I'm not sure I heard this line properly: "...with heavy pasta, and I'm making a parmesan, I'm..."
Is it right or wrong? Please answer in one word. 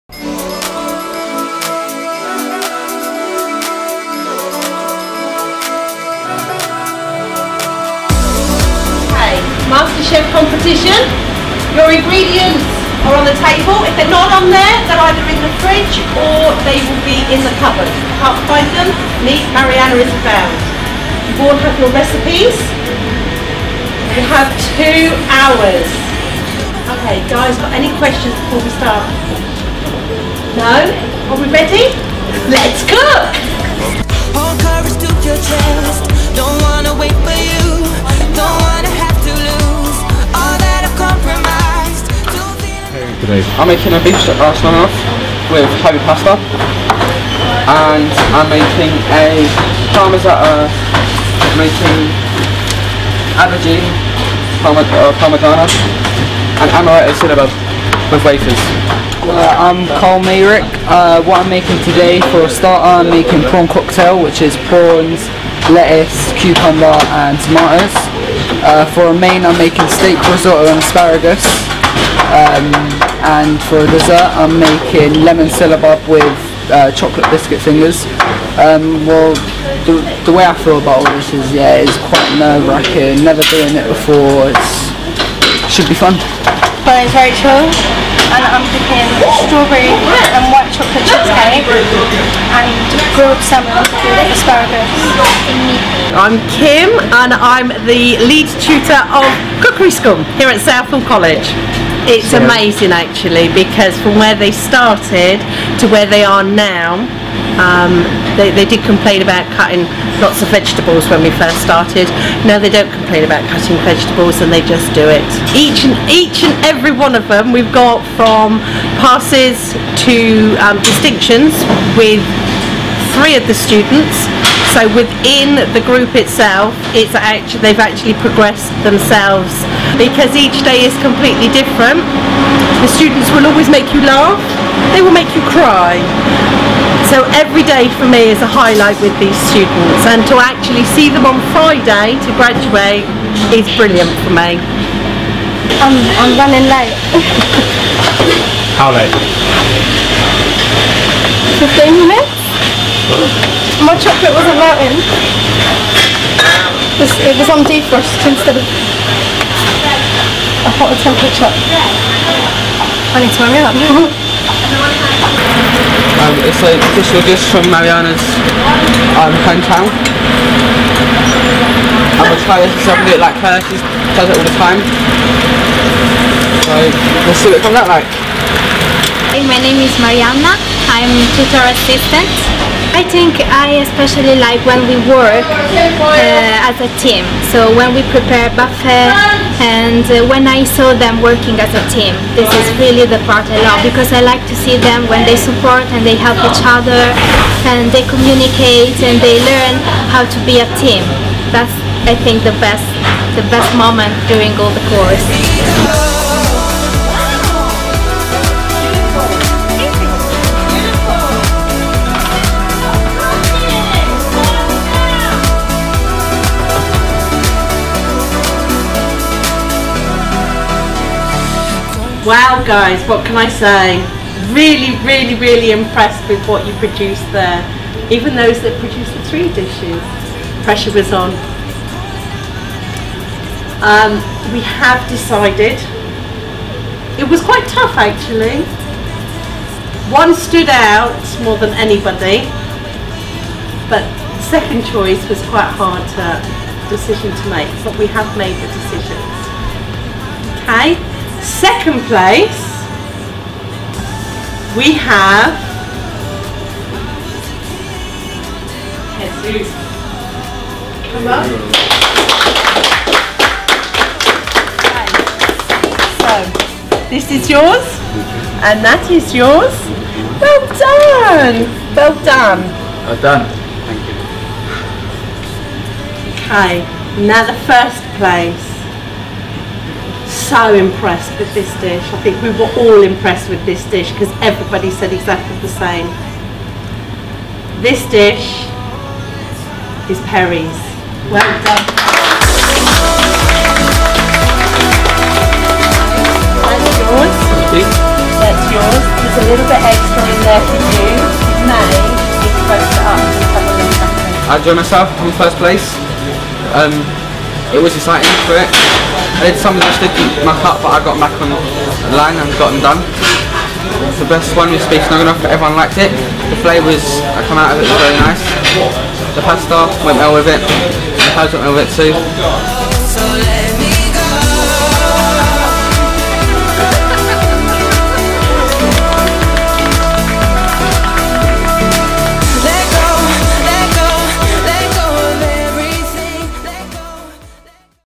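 right.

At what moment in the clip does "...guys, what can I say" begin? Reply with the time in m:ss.
3:42.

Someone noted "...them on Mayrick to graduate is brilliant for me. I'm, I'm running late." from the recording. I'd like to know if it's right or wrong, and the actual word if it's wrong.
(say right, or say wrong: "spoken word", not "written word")
wrong: "Friday", not "Mayrick".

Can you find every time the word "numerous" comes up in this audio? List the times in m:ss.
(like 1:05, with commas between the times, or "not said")
not said.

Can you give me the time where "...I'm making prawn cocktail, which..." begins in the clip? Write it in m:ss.
1:02.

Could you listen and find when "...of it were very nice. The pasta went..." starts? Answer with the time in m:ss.
5:17.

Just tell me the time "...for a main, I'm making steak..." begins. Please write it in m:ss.
1:08.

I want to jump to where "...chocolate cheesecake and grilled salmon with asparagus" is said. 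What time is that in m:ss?
1:30.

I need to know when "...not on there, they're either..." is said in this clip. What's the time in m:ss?
0:14.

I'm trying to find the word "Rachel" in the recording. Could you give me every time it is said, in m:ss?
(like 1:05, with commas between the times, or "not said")
1:27.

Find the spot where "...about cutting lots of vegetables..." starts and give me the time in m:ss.
1:49.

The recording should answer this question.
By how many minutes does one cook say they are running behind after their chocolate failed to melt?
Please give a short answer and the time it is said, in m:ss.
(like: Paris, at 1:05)
15, at 2:31.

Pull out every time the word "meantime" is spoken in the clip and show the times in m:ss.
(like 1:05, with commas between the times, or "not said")
not said.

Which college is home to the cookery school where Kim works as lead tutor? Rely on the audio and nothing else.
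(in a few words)
Southall College.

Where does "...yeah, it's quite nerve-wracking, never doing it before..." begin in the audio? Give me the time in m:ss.
1:21.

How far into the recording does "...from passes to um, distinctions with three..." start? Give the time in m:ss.
1:58.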